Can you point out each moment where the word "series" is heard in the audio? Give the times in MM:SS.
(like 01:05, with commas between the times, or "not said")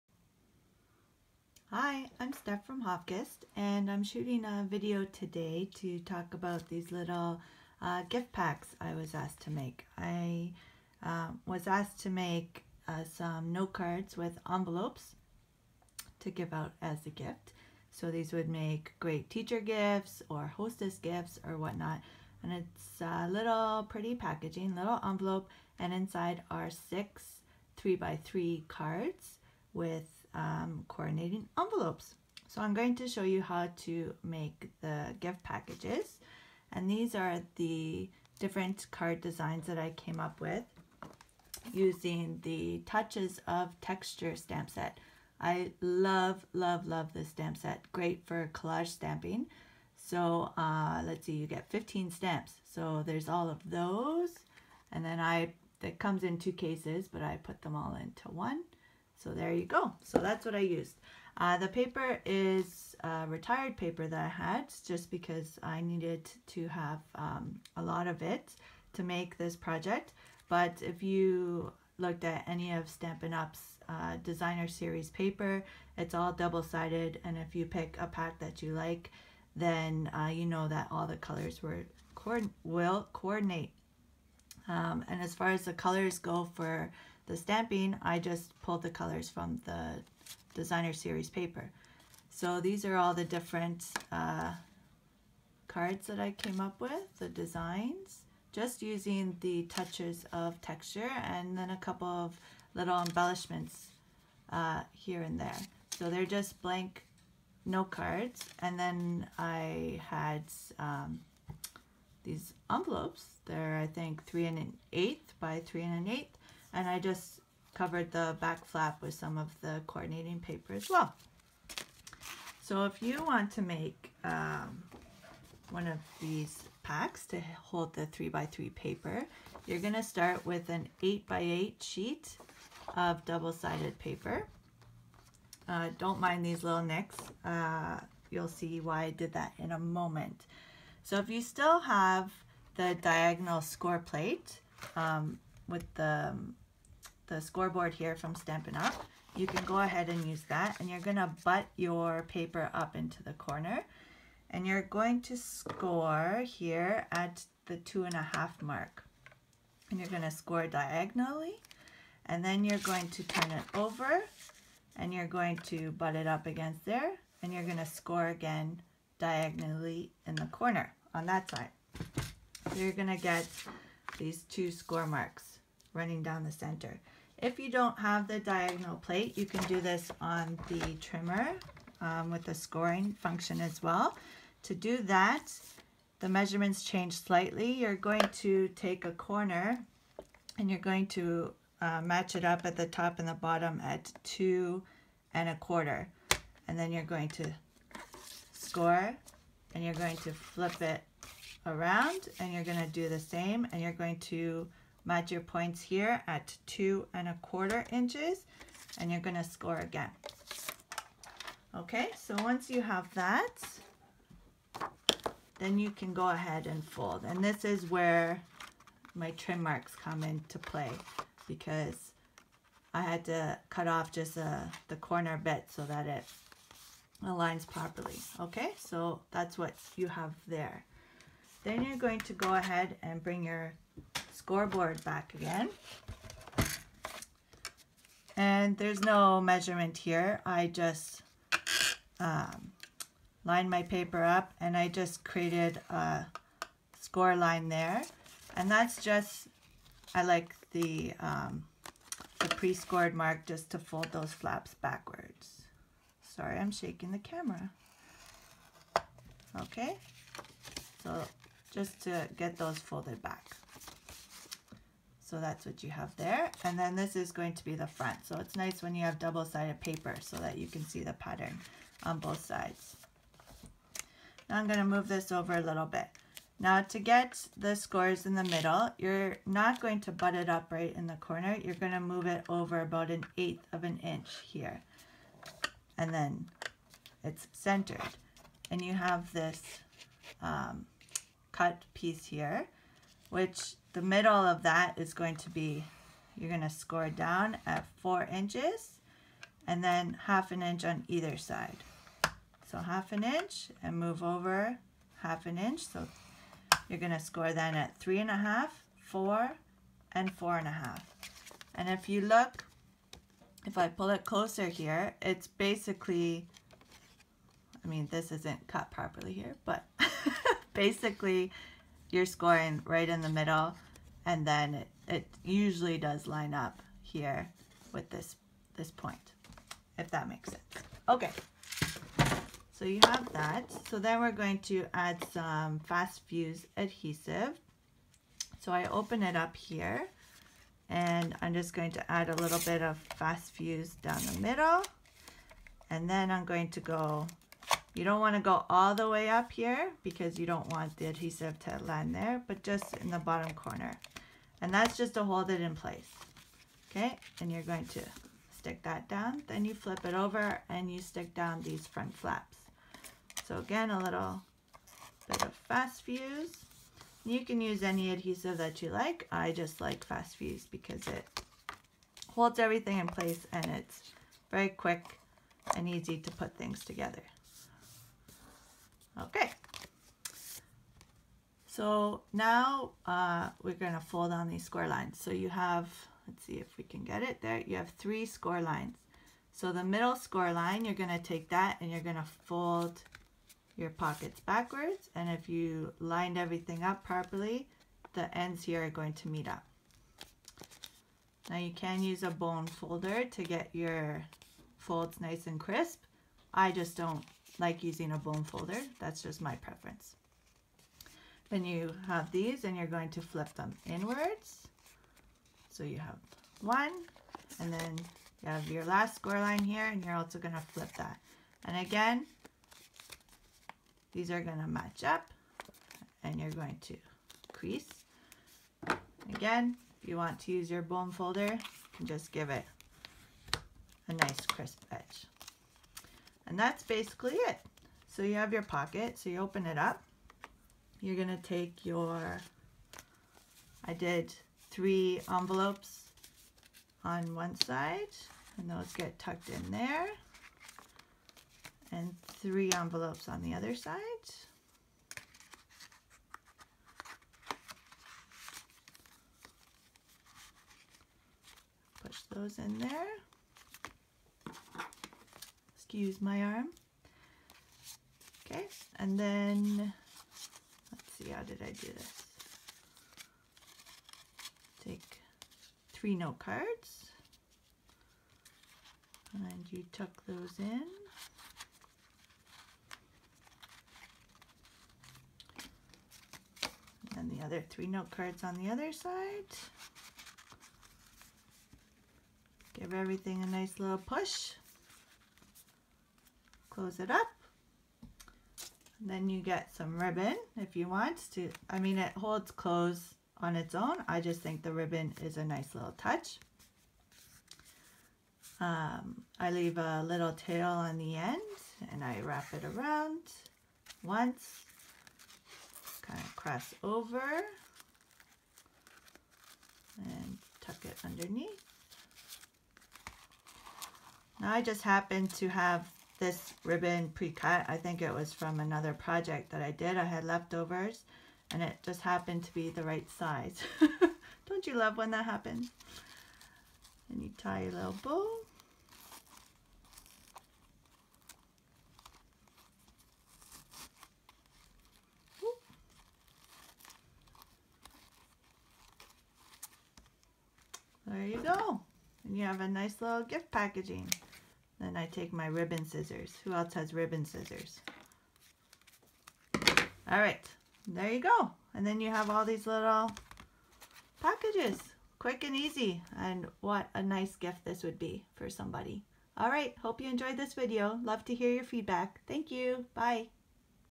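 01:14, 01:30.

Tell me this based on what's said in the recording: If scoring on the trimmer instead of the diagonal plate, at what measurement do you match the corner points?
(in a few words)
2 1/4 inches.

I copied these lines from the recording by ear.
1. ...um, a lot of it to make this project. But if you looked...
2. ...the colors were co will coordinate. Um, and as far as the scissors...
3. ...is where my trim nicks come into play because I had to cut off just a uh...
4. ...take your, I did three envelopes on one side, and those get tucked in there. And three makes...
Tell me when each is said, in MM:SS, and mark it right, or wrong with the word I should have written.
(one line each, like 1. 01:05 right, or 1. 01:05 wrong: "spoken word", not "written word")
1. 01:07 right
2. 01:21 wrong: "colors", not "scissors"
3. 03:37 wrong: "marks", not "nicks"
4. 07:21 wrong: "envelopes", not "makes".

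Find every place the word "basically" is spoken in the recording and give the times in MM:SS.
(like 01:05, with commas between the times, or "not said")
05:15, 05:20, 07:16.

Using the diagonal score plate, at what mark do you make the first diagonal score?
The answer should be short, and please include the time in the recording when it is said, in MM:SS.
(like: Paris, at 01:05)
2 1/2, at 02:37.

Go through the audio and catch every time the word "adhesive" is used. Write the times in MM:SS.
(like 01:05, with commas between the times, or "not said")
05:36, 05:51, 06:08.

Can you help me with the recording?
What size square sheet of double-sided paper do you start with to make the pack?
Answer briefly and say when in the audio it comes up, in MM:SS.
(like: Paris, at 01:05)
8x8, at 02:11.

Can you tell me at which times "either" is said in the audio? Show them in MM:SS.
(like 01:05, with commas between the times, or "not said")
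05:01.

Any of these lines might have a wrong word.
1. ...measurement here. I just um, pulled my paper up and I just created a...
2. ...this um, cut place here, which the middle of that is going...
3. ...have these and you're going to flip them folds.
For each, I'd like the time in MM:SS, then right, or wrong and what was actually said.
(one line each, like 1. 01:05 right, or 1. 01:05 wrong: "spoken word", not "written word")
1. 03:59 wrong: "lined", not "pulled"
2. 04:49 wrong: "piece", not "place"
3. 06:52 wrong: "inwards", not "folds".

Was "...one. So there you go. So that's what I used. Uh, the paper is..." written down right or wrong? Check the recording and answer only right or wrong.
right.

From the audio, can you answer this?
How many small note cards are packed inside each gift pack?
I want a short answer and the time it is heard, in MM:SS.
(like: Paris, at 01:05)
6, at 00:26.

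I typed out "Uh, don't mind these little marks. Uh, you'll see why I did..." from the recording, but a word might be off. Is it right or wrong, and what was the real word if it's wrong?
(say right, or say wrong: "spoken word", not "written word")
wrong: "nicks", not "marks".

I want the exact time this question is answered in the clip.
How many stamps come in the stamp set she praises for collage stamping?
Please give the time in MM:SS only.
00:51.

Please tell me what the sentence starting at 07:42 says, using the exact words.
Push those in there excuse my arm.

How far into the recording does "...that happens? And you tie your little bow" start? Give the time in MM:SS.
08:55.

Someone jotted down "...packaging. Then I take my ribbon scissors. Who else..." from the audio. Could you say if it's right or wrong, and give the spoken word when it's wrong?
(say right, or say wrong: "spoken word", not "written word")
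right.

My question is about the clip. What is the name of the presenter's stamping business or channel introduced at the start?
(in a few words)
Hofkissed.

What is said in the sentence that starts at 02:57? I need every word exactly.
If you don't have the diagonal plate, you can do this on the trimmer um, with the scoring function as well.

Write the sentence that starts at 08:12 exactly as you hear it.
Give everything a nice little push close it up.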